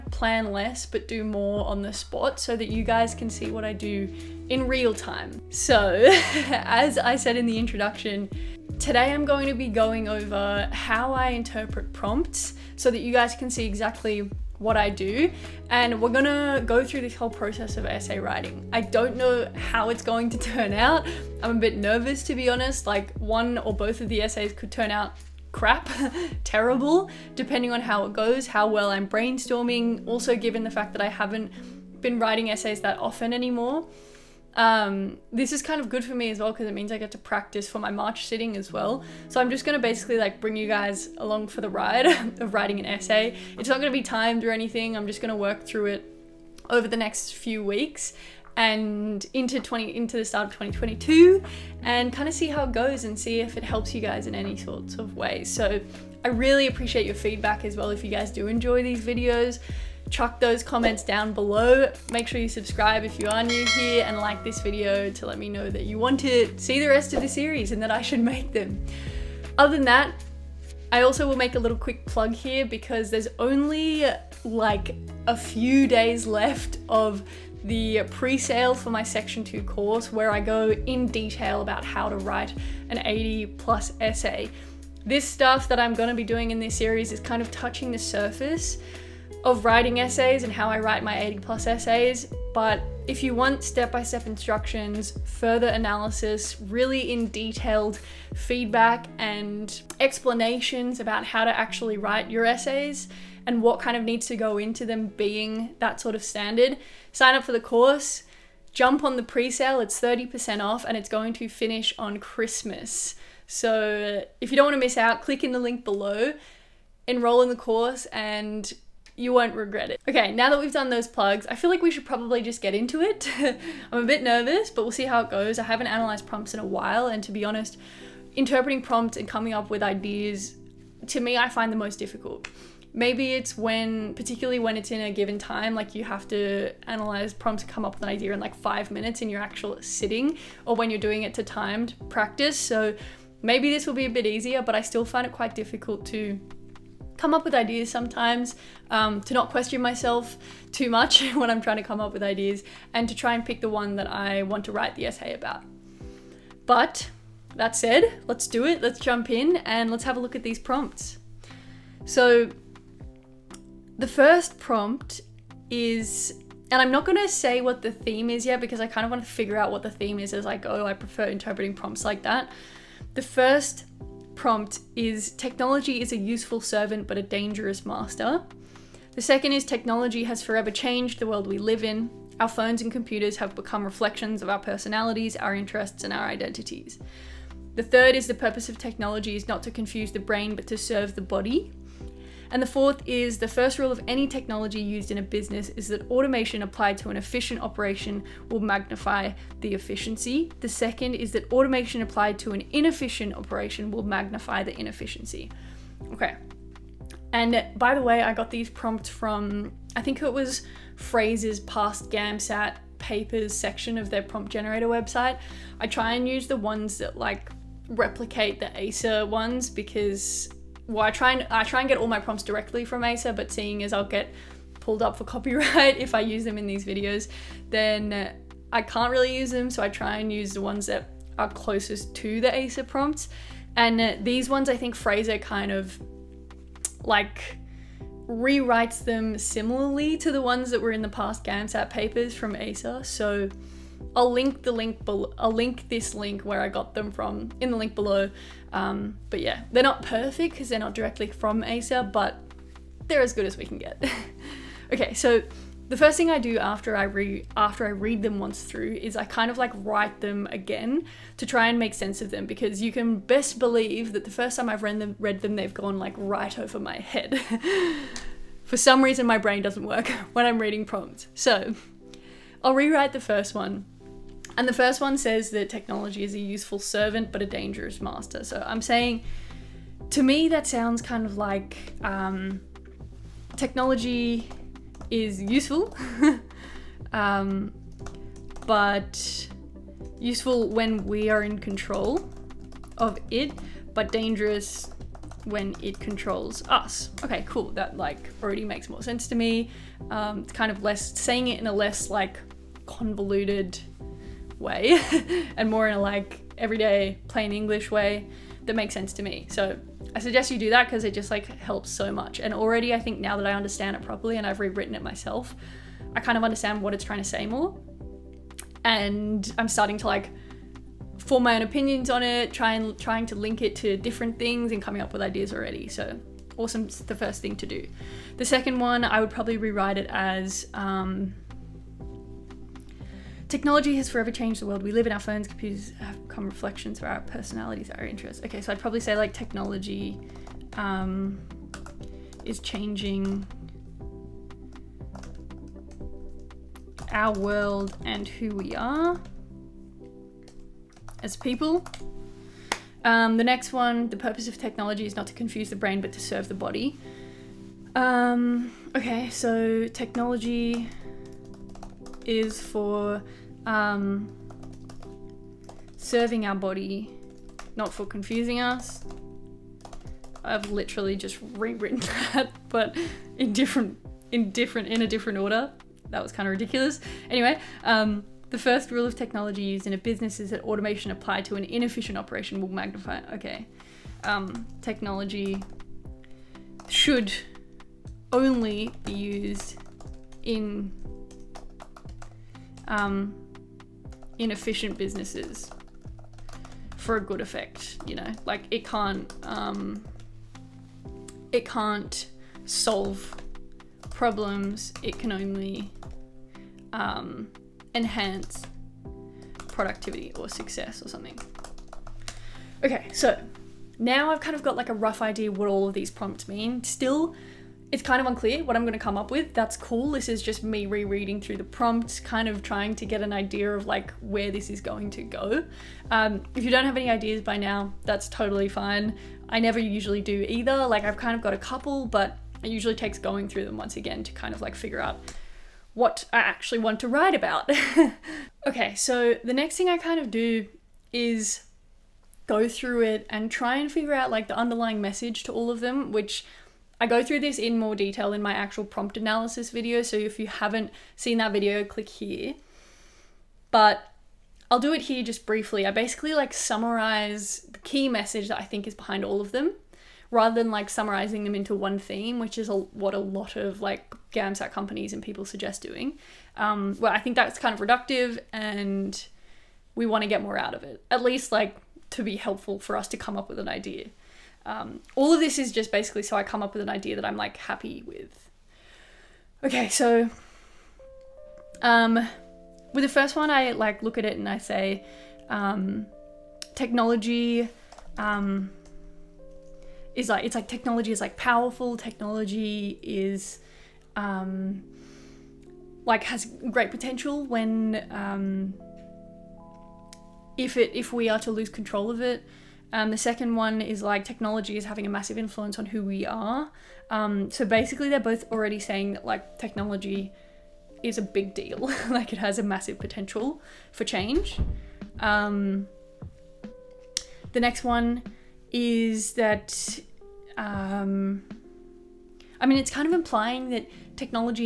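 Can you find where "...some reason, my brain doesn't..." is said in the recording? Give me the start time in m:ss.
4:28.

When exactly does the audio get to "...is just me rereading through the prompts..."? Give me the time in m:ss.
7:00.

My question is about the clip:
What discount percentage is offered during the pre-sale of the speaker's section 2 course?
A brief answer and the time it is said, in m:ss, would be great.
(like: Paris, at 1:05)
30%, at 1:49.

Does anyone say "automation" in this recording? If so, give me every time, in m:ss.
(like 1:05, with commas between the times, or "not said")
3:16, 3:21, 6:20.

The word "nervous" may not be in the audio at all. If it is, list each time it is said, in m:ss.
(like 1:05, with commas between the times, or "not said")
0:21, 2:04.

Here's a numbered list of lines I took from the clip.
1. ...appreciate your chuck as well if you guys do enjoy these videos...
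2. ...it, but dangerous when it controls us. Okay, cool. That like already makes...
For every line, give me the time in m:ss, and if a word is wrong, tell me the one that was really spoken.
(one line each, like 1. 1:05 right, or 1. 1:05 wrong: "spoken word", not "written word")
1. 0:56 wrong: "feedback", not "chuck"
2. 4:53 right.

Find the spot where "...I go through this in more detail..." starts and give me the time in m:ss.
7:27.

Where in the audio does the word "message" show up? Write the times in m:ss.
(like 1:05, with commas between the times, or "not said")
7:25, 7:38.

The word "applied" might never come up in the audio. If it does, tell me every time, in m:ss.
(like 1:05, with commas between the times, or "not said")
3:16, 3:22, 6:21.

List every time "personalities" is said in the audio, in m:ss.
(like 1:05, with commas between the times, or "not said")
3:04, 5:37.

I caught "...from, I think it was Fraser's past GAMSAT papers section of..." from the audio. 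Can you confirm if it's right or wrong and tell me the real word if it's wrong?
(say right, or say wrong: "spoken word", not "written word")
right.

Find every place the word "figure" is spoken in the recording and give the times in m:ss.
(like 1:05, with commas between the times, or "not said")
2:49, 7:14, 7:23.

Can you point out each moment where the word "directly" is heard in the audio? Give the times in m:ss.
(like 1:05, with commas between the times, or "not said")
3:42, 4:10.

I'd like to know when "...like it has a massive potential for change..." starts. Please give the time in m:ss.
8:32.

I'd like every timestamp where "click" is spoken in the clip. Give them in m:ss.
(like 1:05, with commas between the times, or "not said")
1:55, 7:31.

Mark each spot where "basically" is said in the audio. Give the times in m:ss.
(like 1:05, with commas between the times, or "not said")
0:39, 7:35, 7:55, 8:27.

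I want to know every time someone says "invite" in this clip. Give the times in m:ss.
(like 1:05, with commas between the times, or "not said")
not said.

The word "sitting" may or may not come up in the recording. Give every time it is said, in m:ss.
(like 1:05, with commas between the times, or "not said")
0:38, 2:19.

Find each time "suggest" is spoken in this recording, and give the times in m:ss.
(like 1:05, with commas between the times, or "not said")
5:10, 7:45.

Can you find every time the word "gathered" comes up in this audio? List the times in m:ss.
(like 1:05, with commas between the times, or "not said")
not said.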